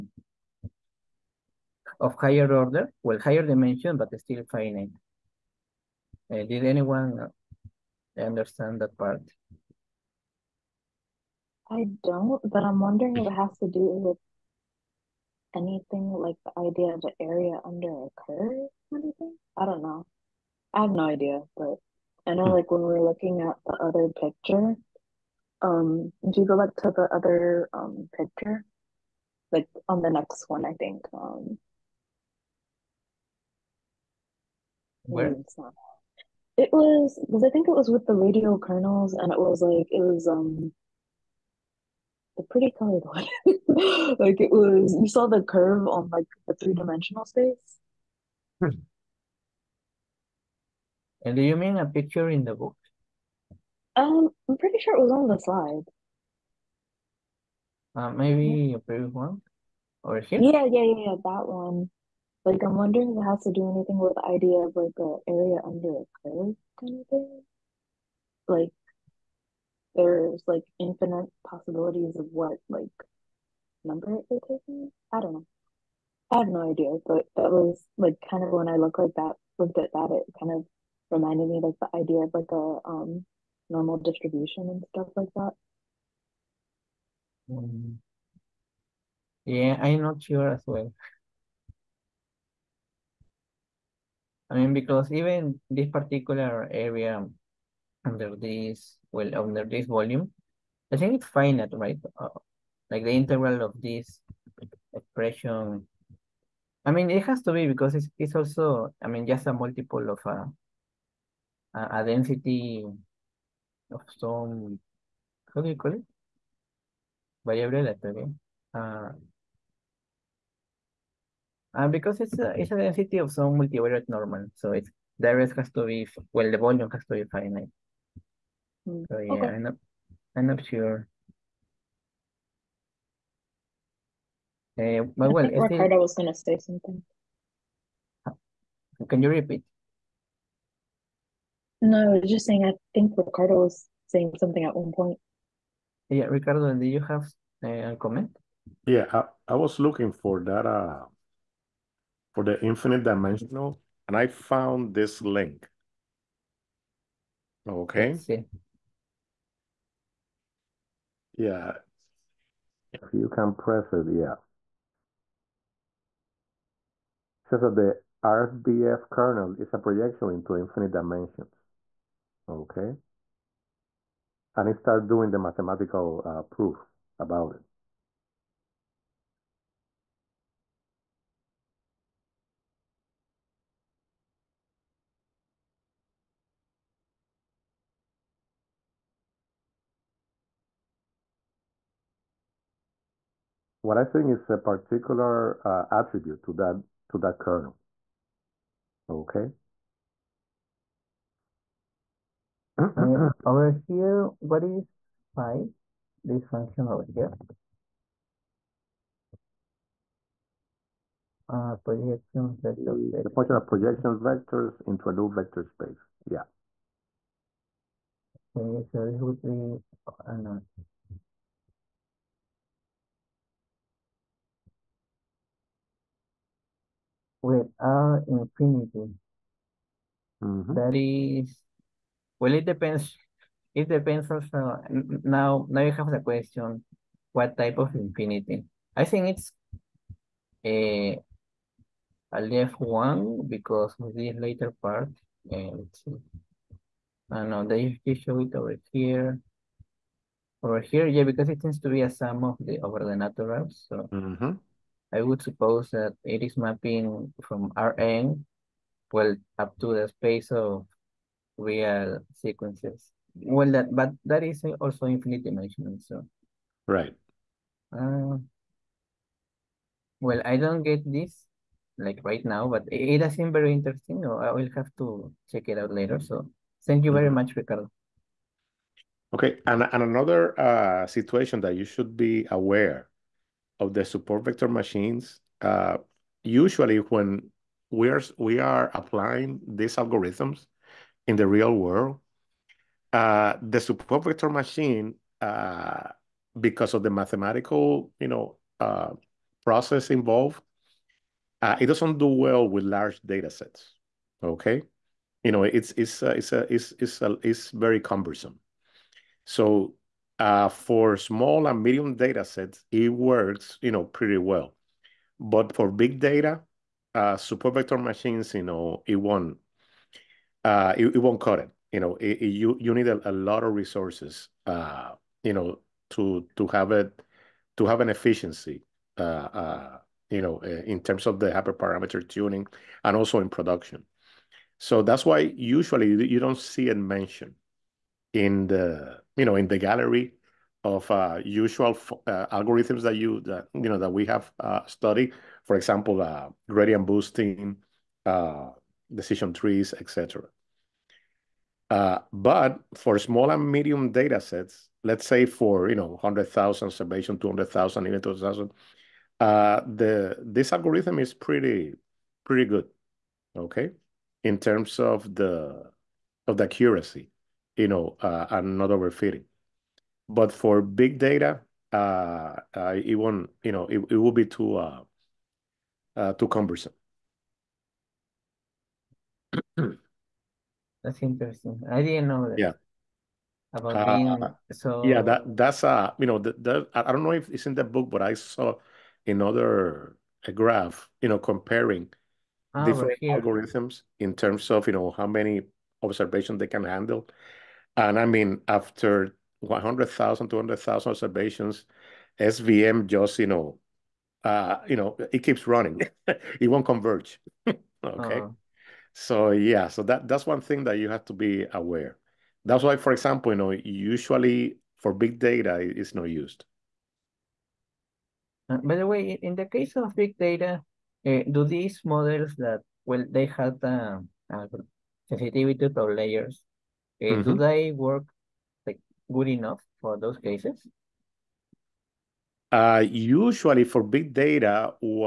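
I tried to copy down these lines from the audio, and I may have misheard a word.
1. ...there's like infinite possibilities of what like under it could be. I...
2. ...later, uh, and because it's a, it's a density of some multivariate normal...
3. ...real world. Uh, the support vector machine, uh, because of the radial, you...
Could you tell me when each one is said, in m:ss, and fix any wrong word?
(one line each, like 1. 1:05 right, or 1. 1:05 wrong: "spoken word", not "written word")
1. 1:09 wrong: "number", not "under"
2. 1:57 wrong: "letter", not "later"
3. 4:51 wrong: "mathematical", not "radial".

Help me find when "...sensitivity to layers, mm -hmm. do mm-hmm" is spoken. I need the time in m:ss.
7:05.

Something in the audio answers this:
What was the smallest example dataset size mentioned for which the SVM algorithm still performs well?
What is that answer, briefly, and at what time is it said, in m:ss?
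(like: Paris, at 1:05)
2,000, at 5:58.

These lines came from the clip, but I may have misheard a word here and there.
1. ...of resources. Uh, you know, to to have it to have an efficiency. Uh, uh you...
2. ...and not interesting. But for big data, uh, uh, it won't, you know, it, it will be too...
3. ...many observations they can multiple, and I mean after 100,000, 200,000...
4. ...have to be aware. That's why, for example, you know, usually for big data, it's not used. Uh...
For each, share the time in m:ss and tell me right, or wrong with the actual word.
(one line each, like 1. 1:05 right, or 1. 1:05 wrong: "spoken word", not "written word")
1. 5:23 right
2. 6:08 wrong: "overfitting", not "interesting"
3. 6:35 wrong: "handle", not "multiple"
4. 6:51 right.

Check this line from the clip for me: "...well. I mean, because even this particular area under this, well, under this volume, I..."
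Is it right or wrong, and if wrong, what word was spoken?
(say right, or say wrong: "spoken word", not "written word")
right.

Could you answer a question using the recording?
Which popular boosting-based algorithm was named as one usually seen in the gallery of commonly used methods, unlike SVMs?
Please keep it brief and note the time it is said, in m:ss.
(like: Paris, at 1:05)
gradient boosting, at 5:46.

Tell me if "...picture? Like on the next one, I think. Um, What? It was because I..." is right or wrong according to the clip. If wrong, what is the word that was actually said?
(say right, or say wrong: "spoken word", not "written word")
wrong: "Where", not "What".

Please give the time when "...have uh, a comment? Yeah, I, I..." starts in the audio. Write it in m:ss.
2:26.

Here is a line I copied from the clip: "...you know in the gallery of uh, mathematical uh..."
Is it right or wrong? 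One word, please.
wrong.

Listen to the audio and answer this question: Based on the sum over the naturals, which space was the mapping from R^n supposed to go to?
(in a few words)
space of real sequences.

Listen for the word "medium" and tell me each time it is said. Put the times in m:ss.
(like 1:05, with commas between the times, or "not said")
5:11, 5:53.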